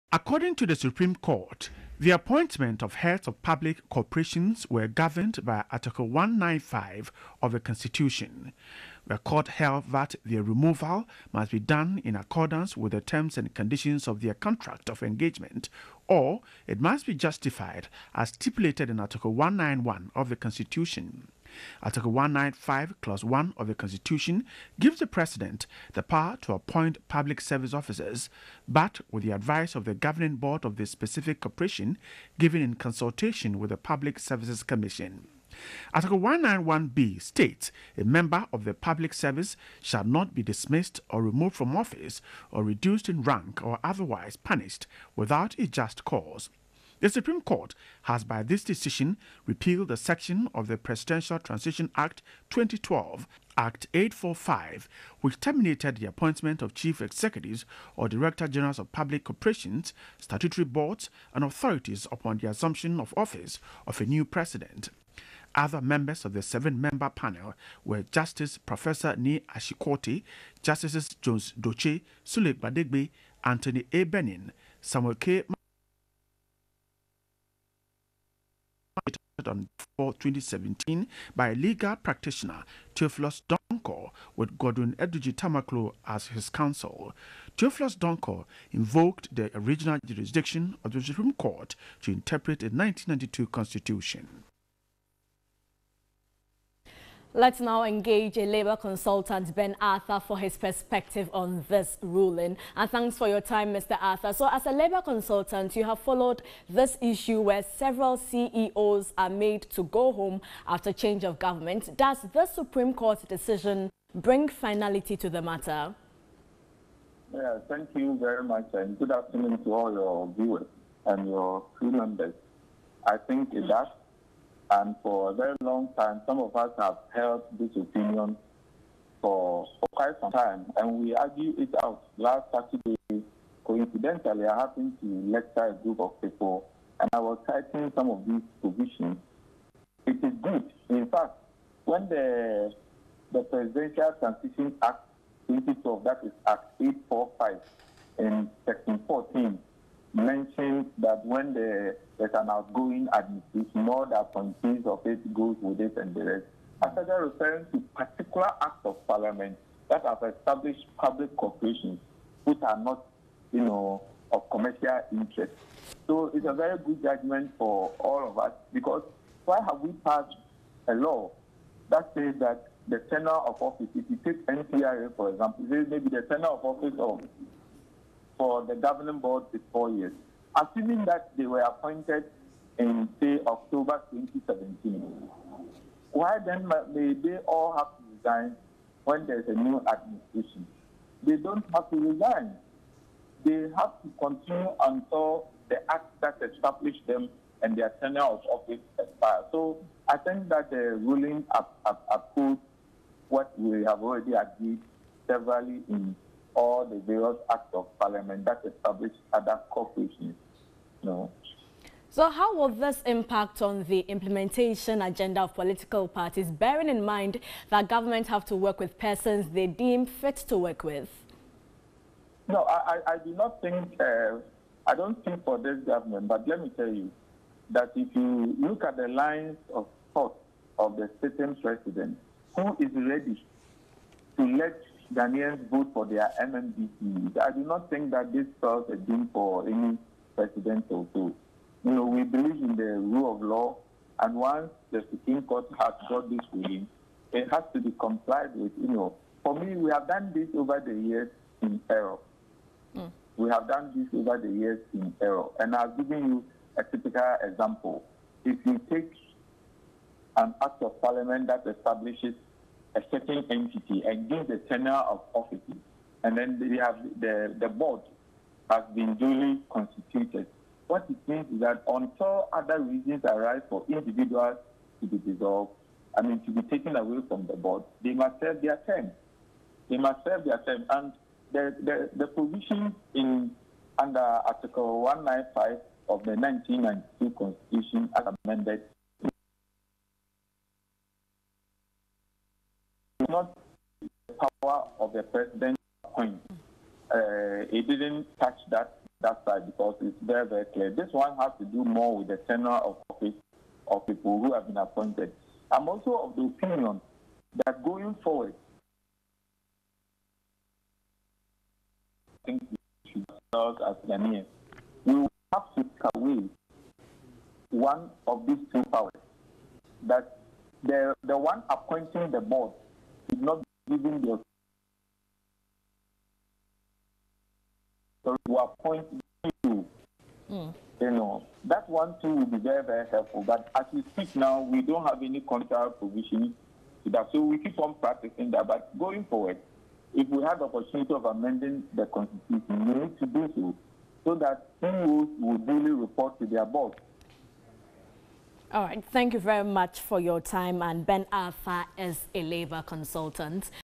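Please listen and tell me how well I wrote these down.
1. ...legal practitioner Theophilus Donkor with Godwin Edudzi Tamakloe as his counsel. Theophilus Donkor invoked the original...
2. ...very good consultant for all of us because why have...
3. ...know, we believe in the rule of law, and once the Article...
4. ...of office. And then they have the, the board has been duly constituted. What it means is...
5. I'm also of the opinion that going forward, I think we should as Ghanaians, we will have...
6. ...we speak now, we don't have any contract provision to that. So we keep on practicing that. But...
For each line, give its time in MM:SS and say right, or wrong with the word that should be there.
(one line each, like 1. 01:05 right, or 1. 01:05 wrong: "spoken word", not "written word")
1. 01:21 right
2. 02:46 wrong: "judgment", not "consultant"
3. 04:01 wrong: "Supreme", not "Article"
4. 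04:25 right
5. 05:05 right
6. 05:33 right.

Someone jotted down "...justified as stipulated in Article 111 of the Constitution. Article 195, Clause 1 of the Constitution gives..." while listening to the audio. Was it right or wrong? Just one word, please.
wrong.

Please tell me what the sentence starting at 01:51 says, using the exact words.
Does the Supreme Court decision bring finality to the matter?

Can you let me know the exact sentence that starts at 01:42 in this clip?
And thanks for your time, Mr.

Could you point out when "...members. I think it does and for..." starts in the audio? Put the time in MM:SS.
02:01.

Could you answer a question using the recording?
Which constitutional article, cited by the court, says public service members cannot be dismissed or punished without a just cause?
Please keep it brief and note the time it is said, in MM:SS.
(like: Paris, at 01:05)
Article 191b, at 00:35.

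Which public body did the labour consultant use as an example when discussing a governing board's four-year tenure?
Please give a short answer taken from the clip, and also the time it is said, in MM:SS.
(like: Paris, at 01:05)
NPRA, at 02:54.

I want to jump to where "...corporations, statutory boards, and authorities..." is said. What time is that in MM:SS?
00:59.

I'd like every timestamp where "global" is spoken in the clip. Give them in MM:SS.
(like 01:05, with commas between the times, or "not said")
not said.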